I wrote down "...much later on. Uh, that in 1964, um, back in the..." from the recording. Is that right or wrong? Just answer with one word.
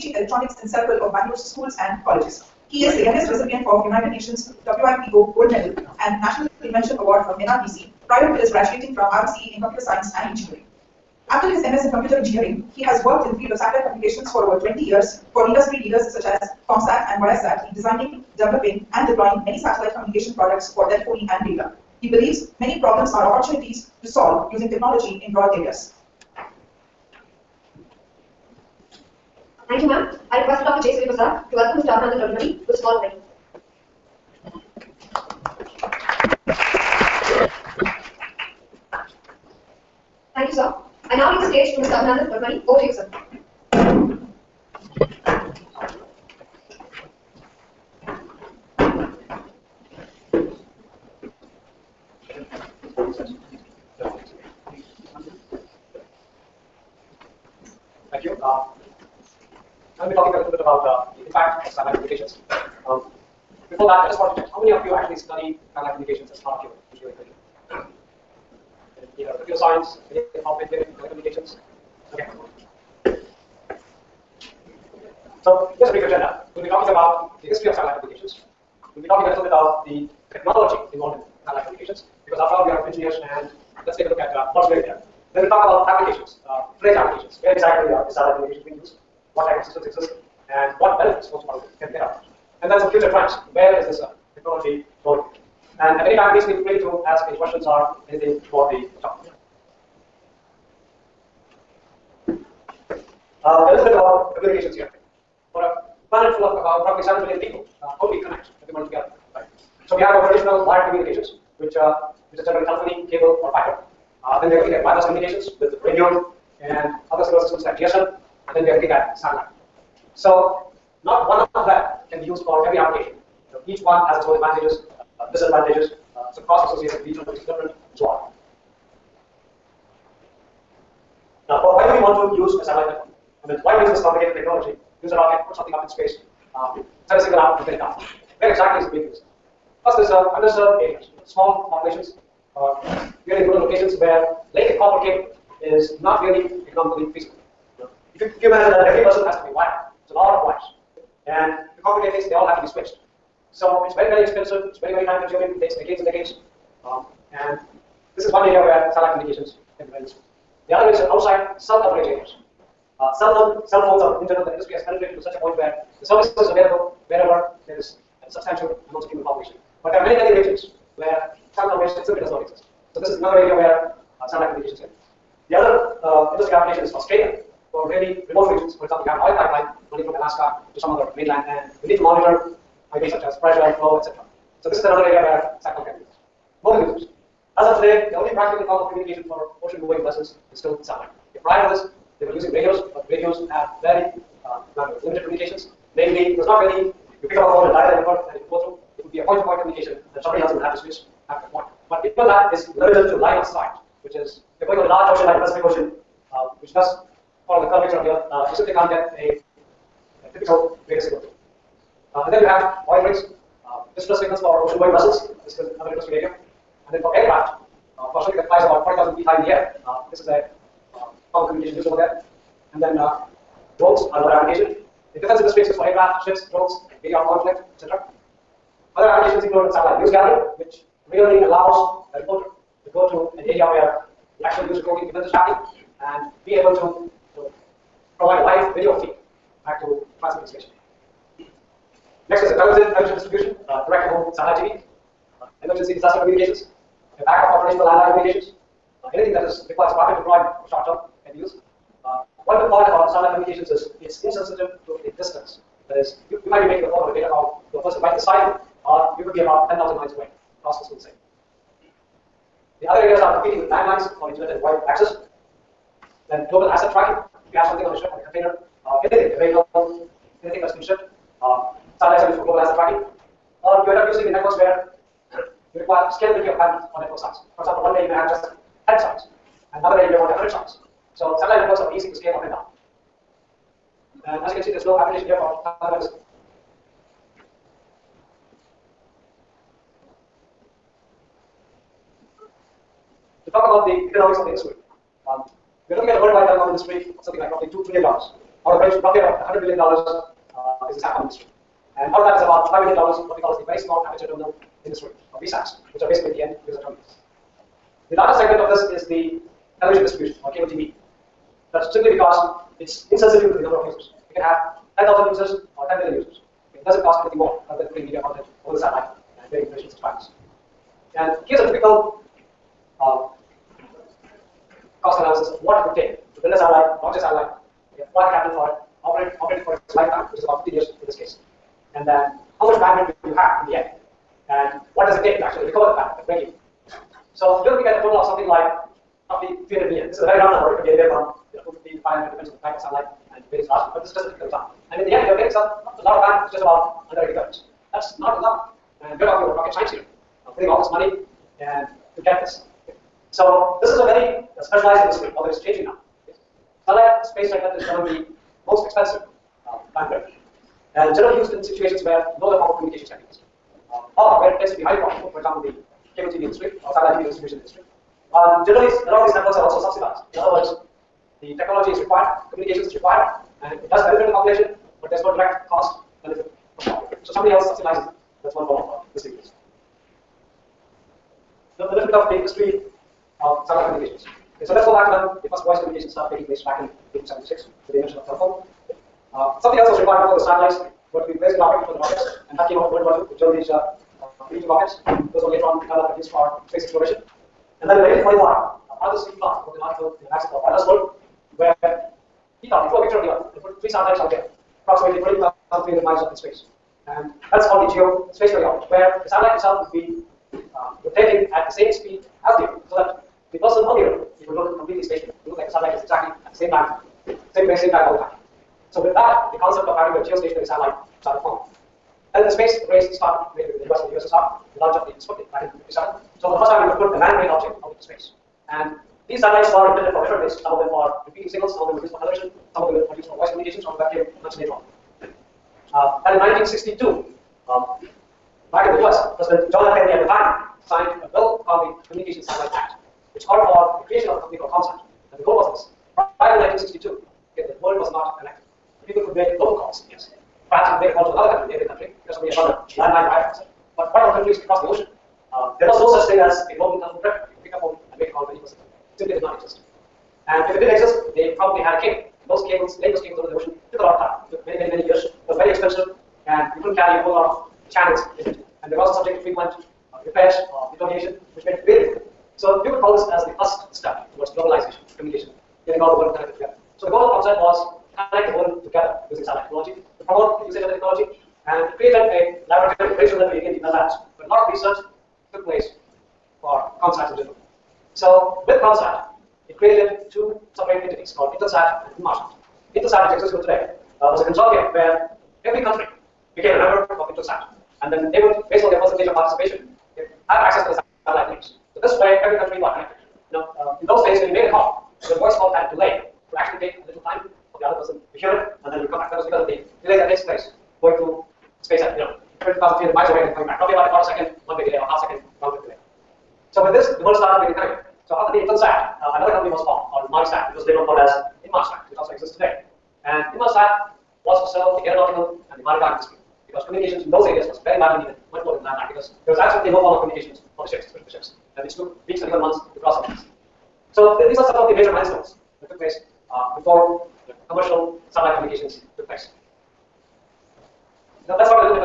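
wrong.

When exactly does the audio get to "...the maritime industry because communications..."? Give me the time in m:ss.
8:45.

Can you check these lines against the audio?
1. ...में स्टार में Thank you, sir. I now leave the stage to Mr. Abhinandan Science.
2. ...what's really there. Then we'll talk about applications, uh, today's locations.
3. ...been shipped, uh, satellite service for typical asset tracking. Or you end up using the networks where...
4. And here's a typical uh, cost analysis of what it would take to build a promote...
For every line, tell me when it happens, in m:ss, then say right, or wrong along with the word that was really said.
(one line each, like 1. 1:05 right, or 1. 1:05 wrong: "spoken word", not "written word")
1. 0:31 wrong: "Dodamani", not "Science"
2. 1:24 wrong: "applications", not "locations"
3. 4:30 wrong: "global", not "typical"
4. 5:21 wrong: "satellite", not "promote".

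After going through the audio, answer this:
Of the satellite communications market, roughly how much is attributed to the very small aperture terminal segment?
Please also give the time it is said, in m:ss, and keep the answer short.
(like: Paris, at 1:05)
$5 billion, at 5:02.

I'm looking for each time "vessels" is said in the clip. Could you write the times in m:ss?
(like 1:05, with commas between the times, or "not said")
3:10, 3:34.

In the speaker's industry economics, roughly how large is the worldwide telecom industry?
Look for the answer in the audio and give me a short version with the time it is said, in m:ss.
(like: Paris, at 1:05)
$2 trillion, at 4:57.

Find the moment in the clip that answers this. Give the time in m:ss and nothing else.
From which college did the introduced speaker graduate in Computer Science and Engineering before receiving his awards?
0:09.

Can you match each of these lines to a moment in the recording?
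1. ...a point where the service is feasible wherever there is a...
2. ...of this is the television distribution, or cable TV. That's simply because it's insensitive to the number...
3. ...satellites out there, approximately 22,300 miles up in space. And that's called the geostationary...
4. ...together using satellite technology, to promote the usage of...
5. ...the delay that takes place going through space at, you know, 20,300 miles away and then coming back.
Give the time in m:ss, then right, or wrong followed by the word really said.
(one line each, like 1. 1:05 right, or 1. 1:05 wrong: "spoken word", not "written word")
1. 2:45 wrong: "available", not "feasible"
2. 5:08 right
3. 6:43 right
4. 7:58 right
5. 8:29 right.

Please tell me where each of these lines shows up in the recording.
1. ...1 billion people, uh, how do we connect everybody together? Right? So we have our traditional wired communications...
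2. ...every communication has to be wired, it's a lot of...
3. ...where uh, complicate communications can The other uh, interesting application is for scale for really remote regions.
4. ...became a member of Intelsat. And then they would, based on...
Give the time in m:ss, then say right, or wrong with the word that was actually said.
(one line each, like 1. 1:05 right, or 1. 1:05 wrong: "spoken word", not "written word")
1. 1:47 wrong: "7", not "1"
2. 2:28 wrong: "person", not "communication"
3. 2:53 wrong: "satellite", not "complicate"
4. 8:16 right.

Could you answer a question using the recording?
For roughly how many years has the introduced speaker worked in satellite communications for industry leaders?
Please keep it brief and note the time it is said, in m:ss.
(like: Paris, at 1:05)
20 years, at 0:14.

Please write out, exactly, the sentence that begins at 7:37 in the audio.
You could pick up phone and make a call to any person.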